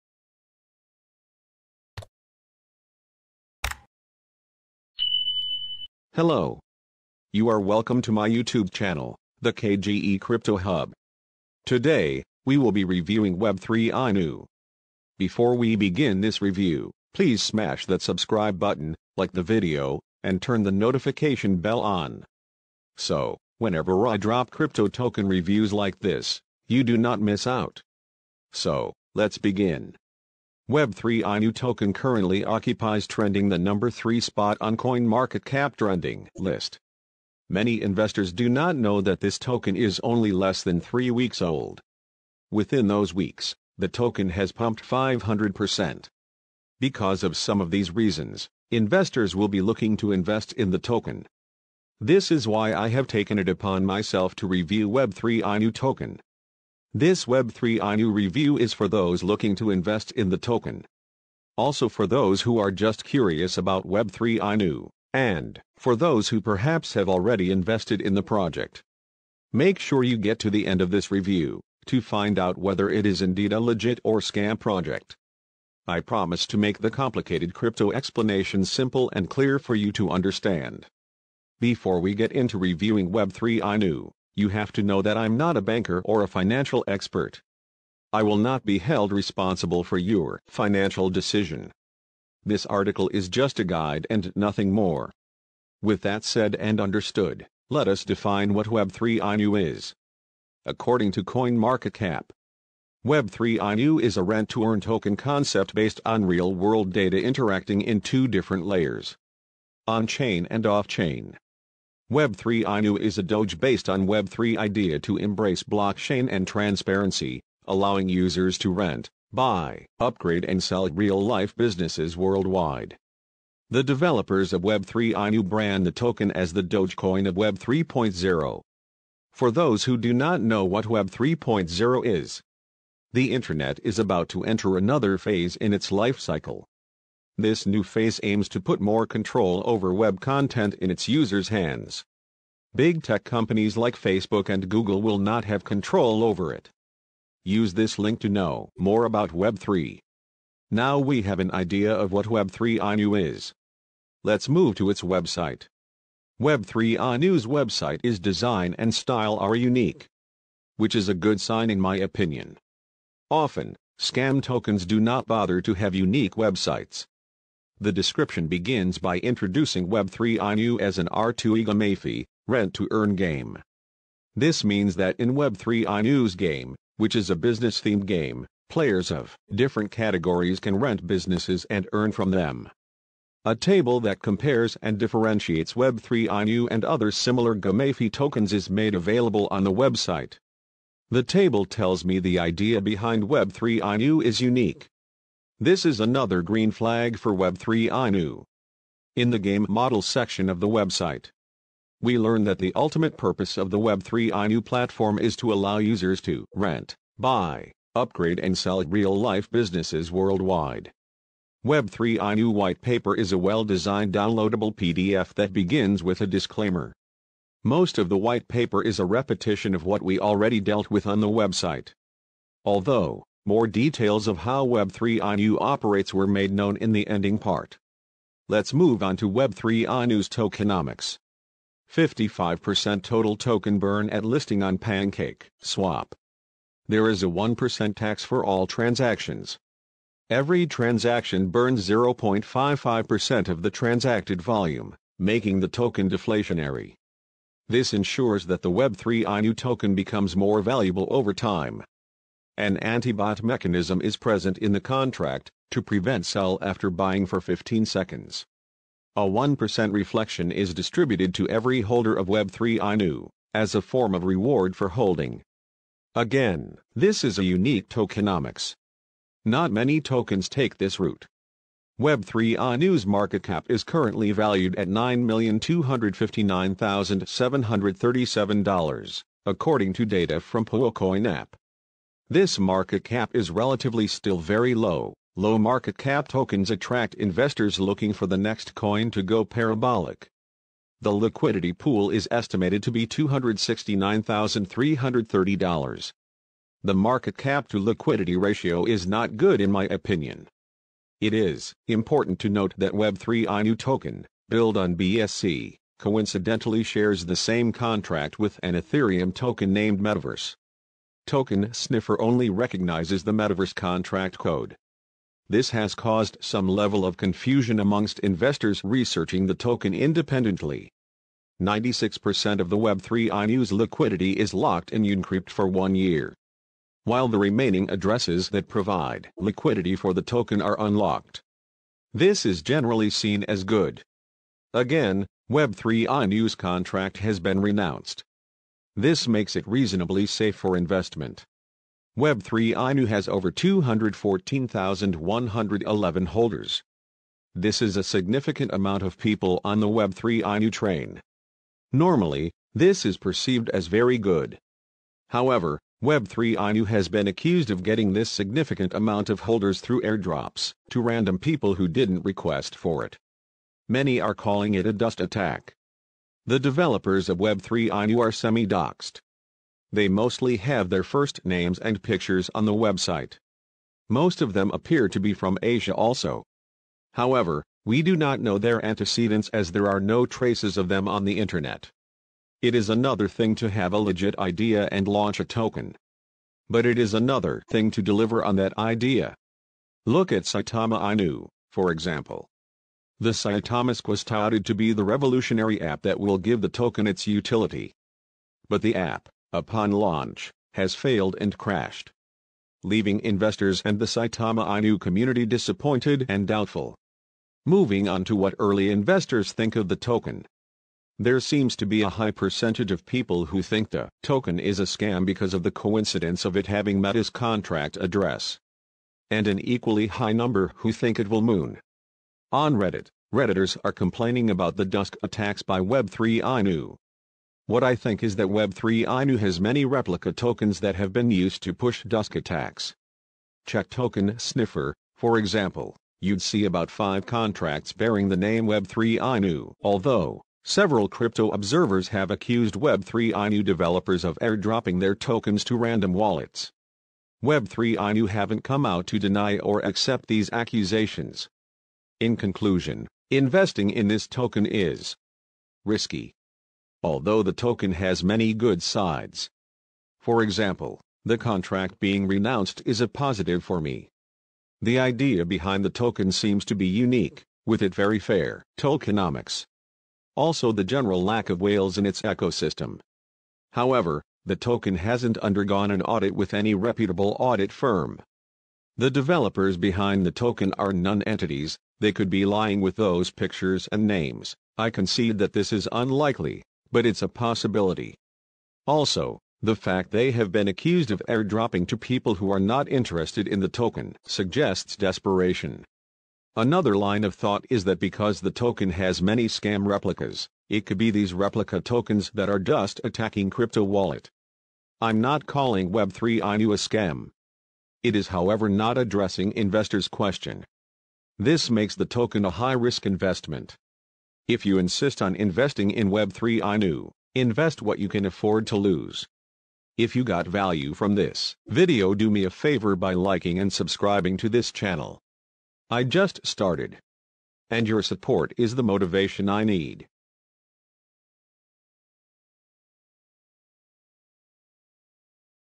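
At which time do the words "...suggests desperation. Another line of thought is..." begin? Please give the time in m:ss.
8:14.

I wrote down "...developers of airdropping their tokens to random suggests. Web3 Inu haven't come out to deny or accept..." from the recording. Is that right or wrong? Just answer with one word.
wrong.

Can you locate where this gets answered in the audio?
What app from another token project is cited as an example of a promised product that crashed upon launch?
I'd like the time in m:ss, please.
6:33.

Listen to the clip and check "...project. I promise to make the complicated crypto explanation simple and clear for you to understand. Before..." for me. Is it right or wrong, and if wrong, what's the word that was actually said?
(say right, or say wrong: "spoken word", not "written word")
right.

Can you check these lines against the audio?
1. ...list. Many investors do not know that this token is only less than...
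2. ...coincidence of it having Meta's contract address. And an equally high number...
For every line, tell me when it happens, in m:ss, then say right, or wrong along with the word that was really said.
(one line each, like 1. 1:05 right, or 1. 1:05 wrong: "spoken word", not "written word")
1. 0:36 right
2. 6:55 right.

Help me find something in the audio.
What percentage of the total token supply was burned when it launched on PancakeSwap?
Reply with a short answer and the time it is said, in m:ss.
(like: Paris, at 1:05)
55%, at 3:51.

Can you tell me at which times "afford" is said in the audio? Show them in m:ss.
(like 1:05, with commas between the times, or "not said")
8:38.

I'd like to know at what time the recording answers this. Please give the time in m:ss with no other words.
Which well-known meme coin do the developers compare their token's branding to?
2:06.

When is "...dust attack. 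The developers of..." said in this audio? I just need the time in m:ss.
6:04.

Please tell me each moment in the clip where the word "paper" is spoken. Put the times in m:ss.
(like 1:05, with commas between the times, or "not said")
3:32, 3:38.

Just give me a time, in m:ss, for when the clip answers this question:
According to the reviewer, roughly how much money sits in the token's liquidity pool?
4:53.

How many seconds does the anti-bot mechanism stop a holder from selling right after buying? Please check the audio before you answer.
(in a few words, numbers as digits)
15.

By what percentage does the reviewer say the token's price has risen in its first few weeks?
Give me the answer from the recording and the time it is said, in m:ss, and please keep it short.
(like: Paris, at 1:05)
500%, at 0:44.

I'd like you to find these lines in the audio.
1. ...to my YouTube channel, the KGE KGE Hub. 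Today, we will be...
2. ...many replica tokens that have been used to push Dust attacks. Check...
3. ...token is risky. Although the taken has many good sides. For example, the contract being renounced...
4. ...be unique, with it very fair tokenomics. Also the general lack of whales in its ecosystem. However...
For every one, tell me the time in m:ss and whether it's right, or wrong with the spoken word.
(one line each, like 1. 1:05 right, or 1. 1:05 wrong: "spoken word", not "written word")
1. 0:08 wrong: "Crypto", not "KGE"
2. 7:09 right
3. 7:34 wrong: "token", not "taken"
4. 7:46 right.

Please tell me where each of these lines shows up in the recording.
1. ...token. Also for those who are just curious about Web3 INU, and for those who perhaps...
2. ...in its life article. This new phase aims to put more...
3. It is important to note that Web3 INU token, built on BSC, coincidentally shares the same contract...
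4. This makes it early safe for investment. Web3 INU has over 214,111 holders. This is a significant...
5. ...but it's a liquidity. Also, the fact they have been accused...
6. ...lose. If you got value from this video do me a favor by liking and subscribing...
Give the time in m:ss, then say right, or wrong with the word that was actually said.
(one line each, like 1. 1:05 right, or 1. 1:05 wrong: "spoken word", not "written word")
1. 1:00 right
2. 2:15 wrong: "cycle", not "article"
3. 5:01 right
4. 5:38 wrong: "reasonably", not "early"
5. 8:06 wrong: "possibility", not "liquidity"
6. 8:38 right.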